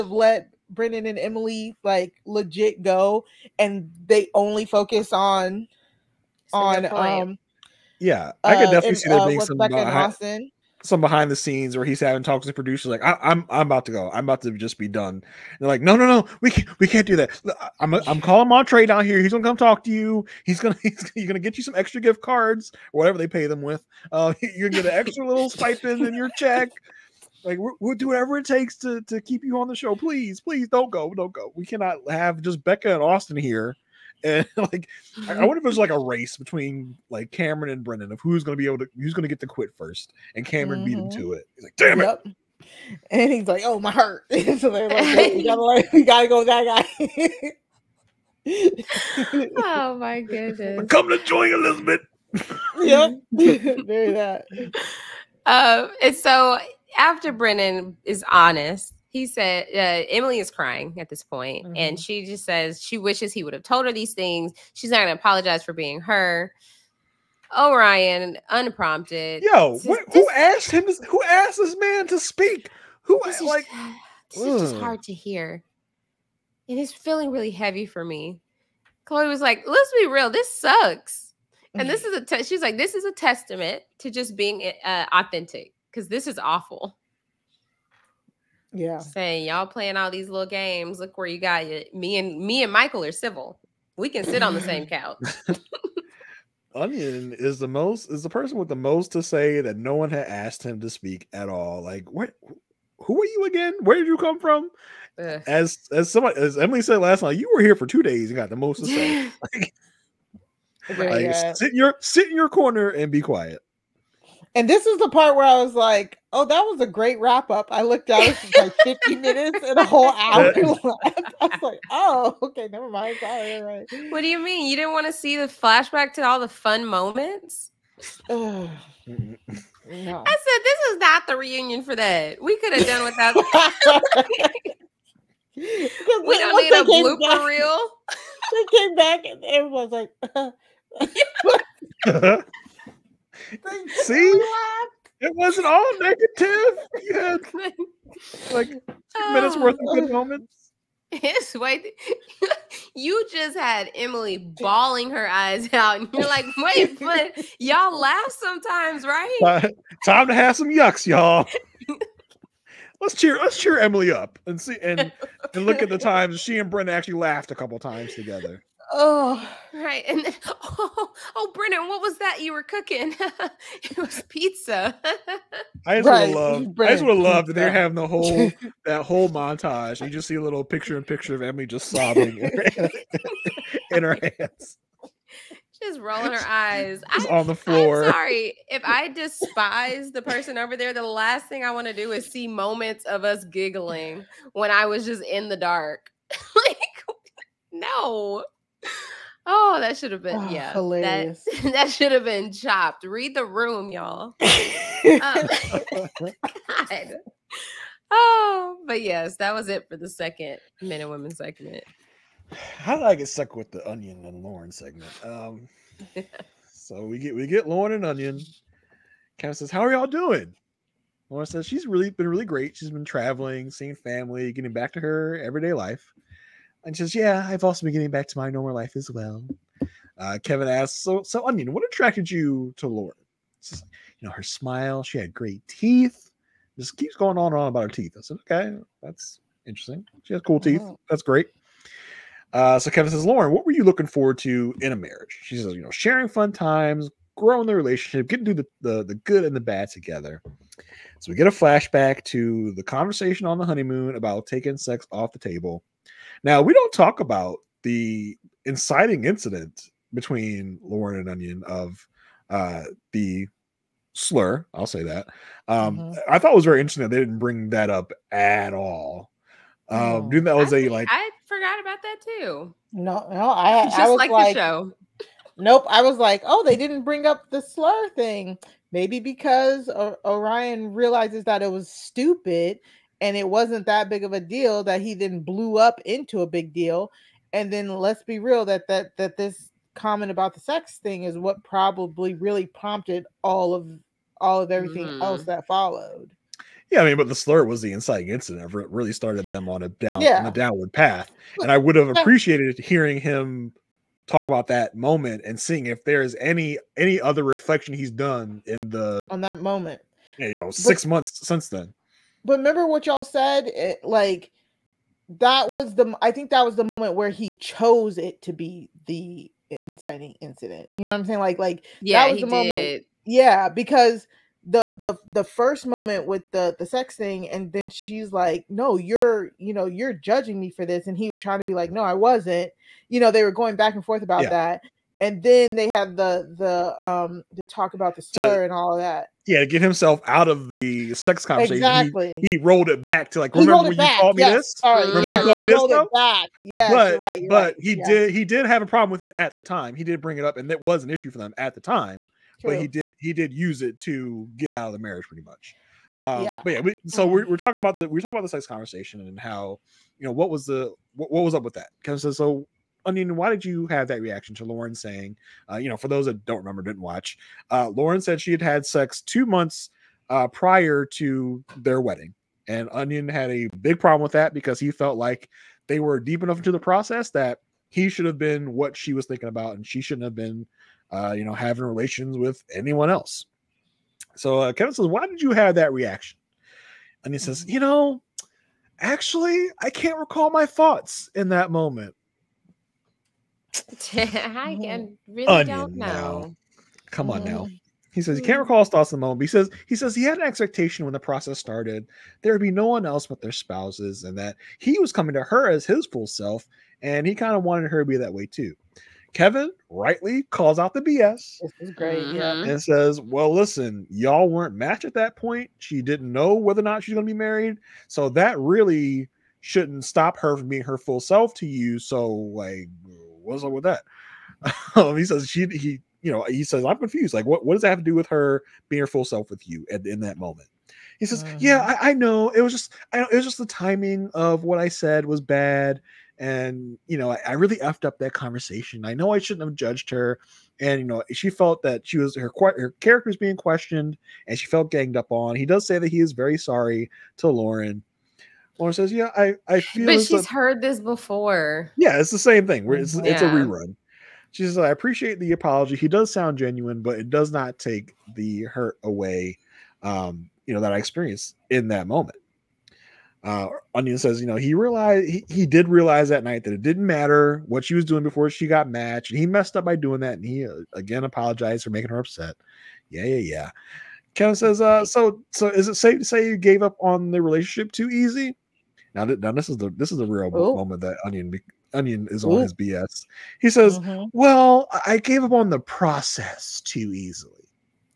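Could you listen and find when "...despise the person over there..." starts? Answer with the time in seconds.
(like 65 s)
189 s.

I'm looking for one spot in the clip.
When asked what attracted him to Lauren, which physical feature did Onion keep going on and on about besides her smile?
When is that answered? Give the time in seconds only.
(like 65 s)
235 s.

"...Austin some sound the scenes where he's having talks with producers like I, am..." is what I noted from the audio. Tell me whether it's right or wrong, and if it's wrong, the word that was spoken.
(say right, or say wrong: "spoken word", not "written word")
wrong: "behind", not "sound".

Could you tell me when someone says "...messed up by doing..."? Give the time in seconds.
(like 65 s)
469 s.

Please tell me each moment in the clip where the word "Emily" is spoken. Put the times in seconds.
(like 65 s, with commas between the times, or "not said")
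1 s, 60 s, 106 s, 153 s, 163 s.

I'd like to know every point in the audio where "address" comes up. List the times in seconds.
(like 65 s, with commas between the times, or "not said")
not said.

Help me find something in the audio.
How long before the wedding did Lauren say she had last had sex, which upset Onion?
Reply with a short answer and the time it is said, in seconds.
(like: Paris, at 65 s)
two months, at 369 s.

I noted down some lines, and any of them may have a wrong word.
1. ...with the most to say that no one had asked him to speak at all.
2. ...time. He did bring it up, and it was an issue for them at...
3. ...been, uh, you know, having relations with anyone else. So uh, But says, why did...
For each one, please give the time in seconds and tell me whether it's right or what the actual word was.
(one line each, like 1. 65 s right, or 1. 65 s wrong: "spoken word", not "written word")
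1. 98 s right
2. 349 s right
3. 380 s wrong: "Kevin", not "But".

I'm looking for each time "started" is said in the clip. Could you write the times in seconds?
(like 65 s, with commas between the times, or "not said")
299 s, 401 s.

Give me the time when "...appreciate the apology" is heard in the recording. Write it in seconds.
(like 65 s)
454 s.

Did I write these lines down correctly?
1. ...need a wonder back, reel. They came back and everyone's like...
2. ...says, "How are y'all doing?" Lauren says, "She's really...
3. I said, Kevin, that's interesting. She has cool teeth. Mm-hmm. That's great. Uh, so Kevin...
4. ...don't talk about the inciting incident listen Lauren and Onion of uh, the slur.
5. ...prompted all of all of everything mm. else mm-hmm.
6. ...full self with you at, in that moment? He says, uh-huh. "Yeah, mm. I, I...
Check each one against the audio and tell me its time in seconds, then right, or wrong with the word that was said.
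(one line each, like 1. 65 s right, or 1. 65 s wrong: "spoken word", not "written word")
1. 136 s wrong: "blooper", not "wonder"
2. 219 s right
3. 238 s wrong: "Okay", not "Kevin"
4. 256 s wrong: "between", not "listen"
5. 292 s right
6. 429 s right.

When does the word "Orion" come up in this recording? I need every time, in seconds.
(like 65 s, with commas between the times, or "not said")
280 s.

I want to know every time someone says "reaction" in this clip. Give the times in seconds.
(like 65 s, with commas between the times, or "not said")
364 s, 385 s.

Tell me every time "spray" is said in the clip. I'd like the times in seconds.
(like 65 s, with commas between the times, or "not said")
not said.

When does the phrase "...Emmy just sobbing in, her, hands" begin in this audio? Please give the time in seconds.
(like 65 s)
181 s.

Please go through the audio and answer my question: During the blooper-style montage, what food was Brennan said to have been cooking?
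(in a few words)
pizza.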